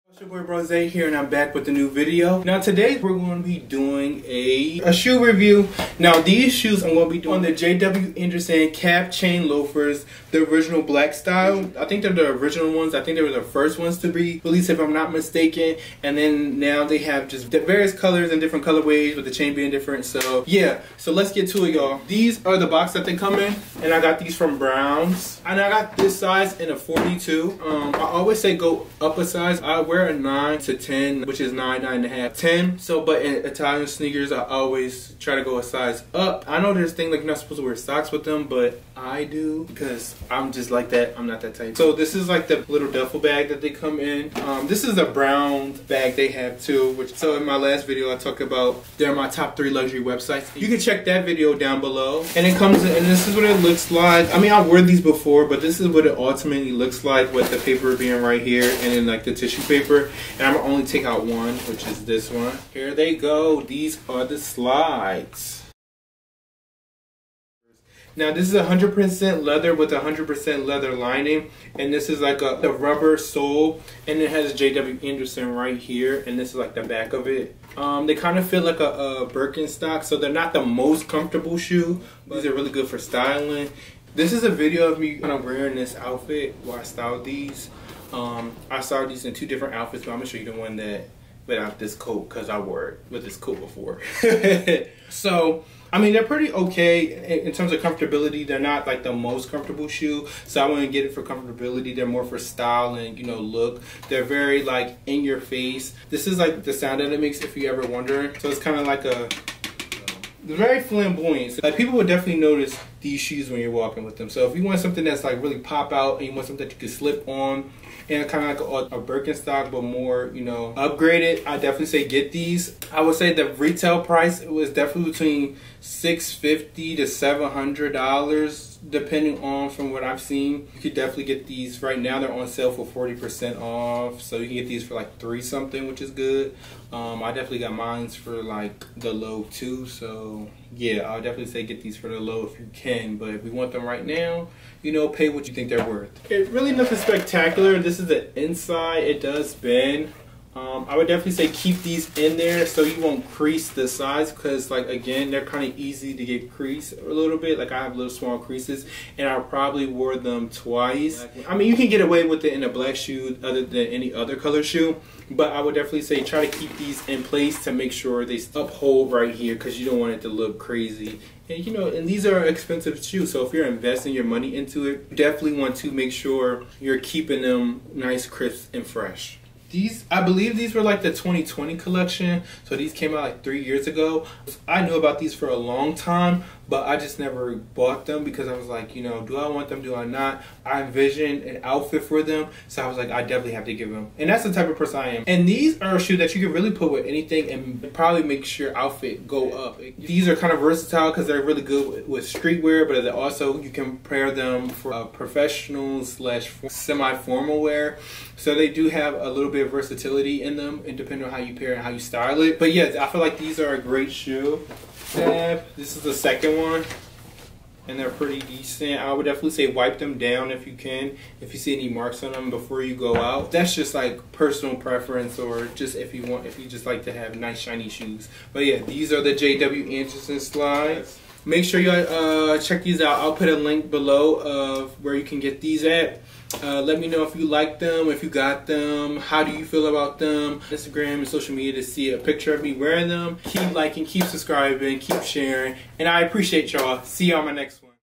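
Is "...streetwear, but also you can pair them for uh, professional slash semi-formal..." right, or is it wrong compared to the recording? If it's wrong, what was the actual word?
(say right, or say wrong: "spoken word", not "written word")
right.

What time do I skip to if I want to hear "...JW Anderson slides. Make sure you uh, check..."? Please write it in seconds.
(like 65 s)
229 s.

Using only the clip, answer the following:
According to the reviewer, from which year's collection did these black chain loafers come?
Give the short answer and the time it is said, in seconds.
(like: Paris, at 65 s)
2020, at 181 s.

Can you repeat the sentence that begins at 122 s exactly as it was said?
I would say the retail price was definitely between 650 to $700 depending on from what I've seen.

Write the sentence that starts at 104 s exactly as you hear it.
They're very like in your face.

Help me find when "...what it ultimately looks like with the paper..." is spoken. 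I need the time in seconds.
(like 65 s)
55 s.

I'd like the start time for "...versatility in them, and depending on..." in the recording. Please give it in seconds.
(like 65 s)
209 s.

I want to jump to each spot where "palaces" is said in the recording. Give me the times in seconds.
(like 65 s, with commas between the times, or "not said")
not said.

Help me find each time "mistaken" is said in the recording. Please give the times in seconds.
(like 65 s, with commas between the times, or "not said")
15 s.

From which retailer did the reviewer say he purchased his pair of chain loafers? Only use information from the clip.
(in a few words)
Browns.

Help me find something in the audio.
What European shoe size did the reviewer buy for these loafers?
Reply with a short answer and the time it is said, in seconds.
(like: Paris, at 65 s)
42, at 26 s.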